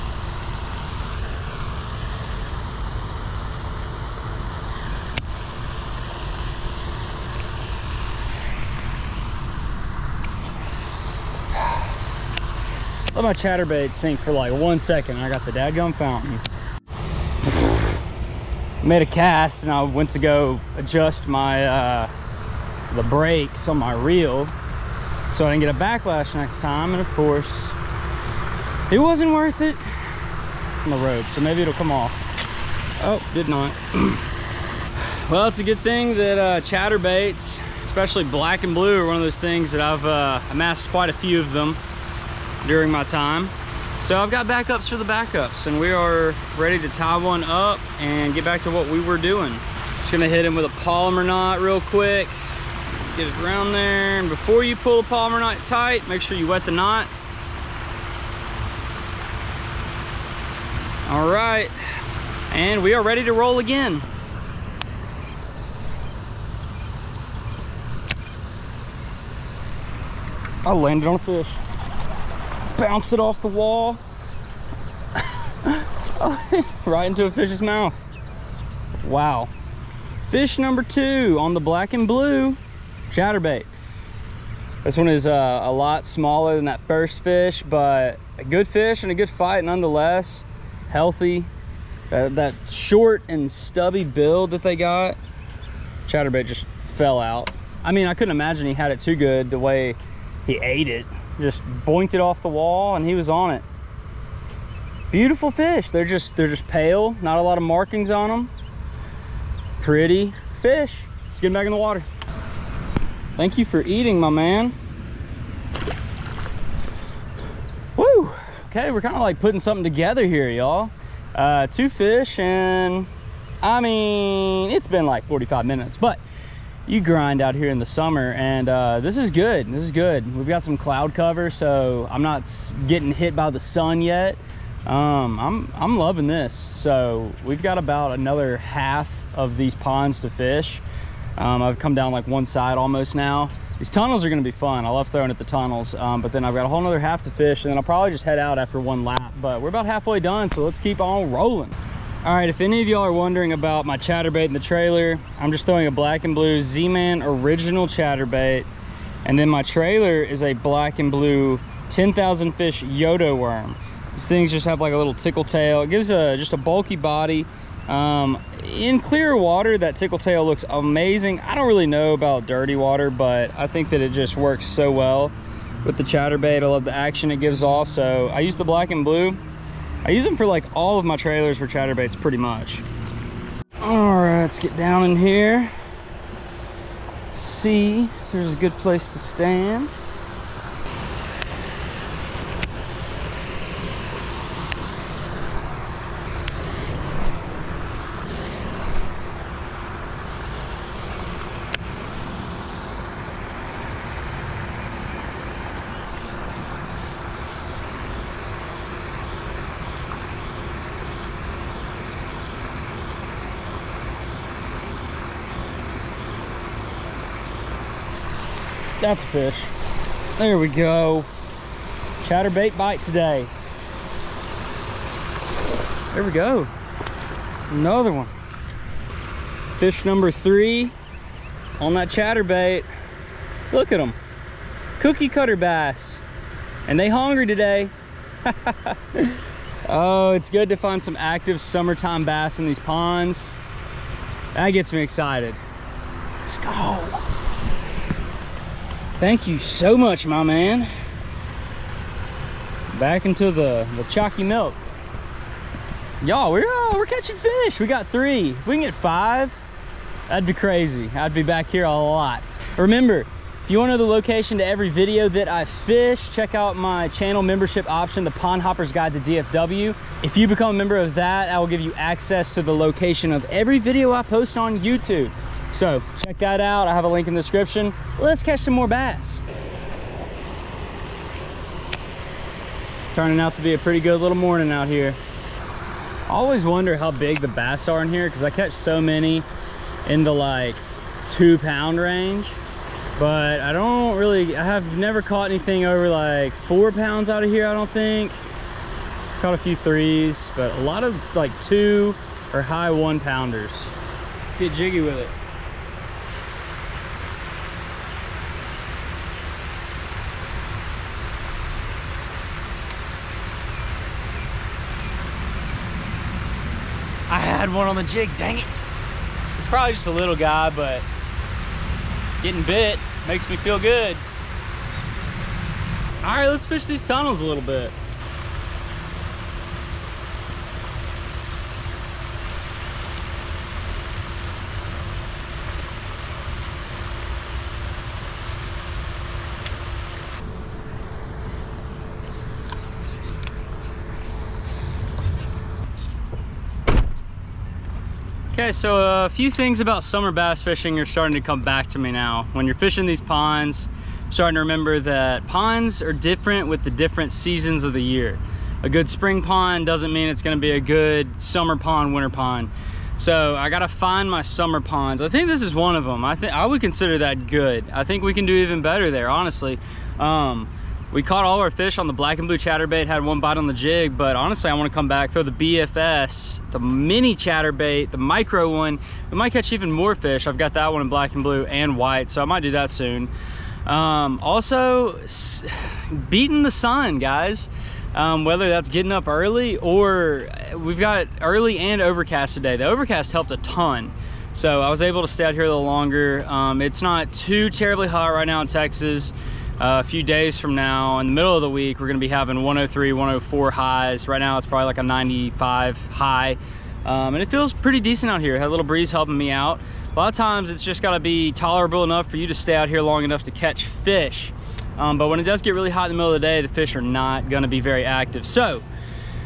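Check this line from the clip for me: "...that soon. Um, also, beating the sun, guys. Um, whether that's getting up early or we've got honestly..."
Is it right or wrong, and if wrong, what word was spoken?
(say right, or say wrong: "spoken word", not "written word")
wrong: "early", not "honestly".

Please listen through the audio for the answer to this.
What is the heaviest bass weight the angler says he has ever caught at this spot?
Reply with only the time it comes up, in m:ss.
4:56.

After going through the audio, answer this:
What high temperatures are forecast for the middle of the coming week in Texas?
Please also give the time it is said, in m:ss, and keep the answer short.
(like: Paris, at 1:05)
103, 104, at 6:42.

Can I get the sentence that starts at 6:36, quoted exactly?
Um, it's not too terribly hot right now in Texas.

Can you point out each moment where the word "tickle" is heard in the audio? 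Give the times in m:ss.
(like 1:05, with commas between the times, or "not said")
2:45, 2:49.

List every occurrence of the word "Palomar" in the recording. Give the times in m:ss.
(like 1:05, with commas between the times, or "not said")
0:50, 0:55.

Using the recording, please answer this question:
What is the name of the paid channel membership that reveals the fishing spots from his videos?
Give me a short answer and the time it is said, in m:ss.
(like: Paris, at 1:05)
Pond Hopper's Guide to DFW, at 4:28.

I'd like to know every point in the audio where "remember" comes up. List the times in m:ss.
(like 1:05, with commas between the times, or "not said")
4:22, 5:54.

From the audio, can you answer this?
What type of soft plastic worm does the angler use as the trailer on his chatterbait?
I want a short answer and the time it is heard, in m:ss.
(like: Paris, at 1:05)
Yodo worm, at 2:42.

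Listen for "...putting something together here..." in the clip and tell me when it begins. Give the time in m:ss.
1:59.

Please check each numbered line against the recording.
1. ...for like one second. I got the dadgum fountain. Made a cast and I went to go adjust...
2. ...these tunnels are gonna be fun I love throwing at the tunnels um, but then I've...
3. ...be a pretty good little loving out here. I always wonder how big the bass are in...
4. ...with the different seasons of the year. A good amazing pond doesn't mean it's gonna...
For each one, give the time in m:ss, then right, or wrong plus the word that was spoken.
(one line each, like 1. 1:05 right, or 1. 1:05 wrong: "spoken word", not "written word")
1. 0:14 right
2. 2:23 right
3. 4:43 wrong: "morning", not "loving"
4. 5:56 wrong: "spring", not "amazing".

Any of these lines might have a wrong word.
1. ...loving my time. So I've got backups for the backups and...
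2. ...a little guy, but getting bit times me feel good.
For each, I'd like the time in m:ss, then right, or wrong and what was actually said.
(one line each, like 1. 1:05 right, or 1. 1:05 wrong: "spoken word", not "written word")
1. 0:42 wrong: "during", not "loving"
2. 5:20 wrong: "makes", not "times".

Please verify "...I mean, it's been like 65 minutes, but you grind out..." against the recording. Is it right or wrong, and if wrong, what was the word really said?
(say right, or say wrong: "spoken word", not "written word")
wrong: "45", not "65".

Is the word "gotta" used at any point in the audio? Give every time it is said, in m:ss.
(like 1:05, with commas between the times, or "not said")
6:03, 6:51.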